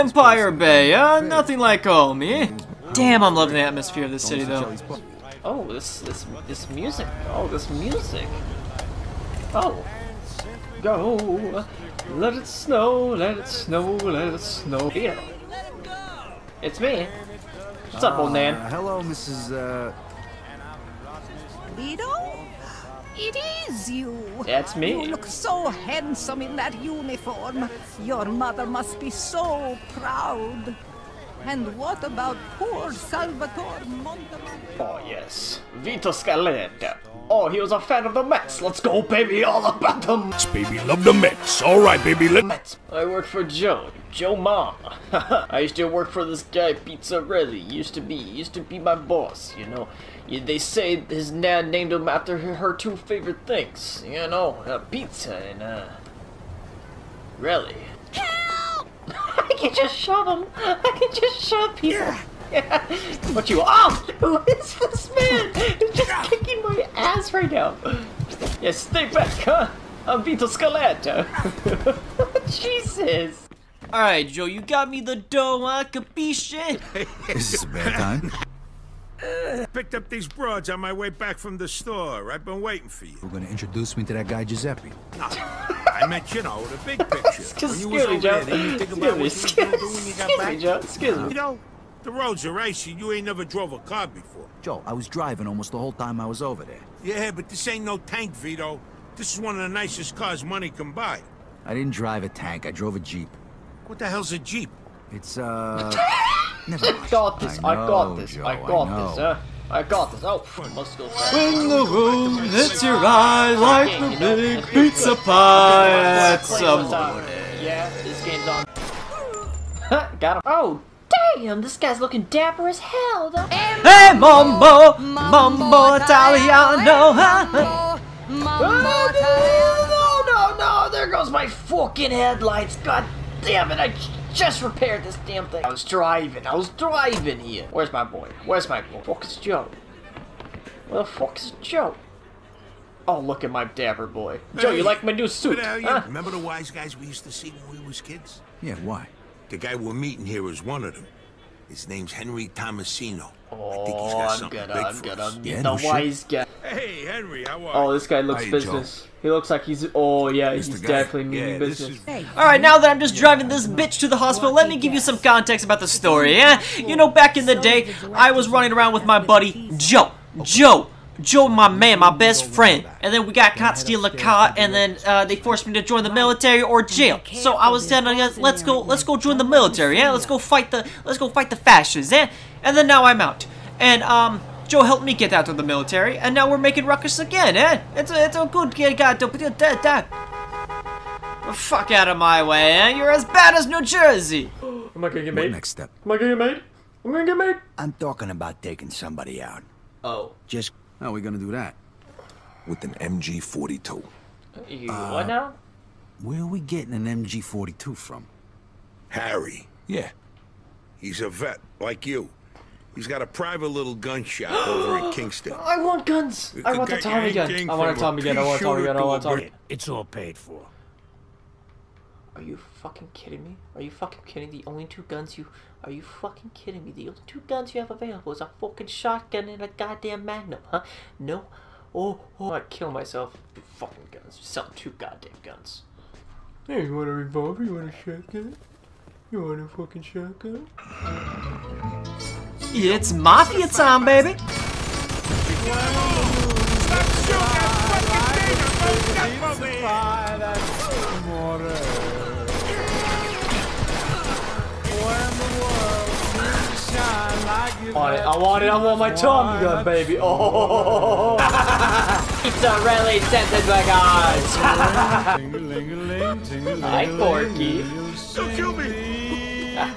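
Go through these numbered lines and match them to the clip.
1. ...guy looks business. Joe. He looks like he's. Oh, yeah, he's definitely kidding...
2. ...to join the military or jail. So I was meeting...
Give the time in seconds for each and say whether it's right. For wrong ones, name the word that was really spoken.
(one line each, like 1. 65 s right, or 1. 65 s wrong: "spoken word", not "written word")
1. 158 s wrong: "meaning", not "kidding"
2. 175 s wrong: "telling", not "meeting".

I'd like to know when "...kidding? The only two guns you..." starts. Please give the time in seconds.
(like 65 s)
224 s.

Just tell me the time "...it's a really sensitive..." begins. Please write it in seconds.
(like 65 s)
262 s.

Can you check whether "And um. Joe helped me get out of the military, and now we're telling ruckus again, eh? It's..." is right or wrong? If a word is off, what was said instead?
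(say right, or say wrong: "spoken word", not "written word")
wrong: "making", not "telling".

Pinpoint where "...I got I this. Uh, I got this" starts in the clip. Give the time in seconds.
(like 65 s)
108 s.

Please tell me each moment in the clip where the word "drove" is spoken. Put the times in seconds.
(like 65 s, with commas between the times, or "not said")
93 s, 102 s.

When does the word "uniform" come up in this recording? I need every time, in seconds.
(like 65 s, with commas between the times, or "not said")
26 s.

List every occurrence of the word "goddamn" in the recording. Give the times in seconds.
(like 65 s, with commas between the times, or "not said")
229 s, 234 s.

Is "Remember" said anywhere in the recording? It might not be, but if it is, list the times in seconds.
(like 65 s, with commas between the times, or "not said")
146 s.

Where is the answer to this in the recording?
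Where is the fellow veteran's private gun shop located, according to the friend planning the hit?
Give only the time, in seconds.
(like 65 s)
215 s.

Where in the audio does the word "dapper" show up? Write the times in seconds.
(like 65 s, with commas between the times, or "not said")
122 s, 143 s.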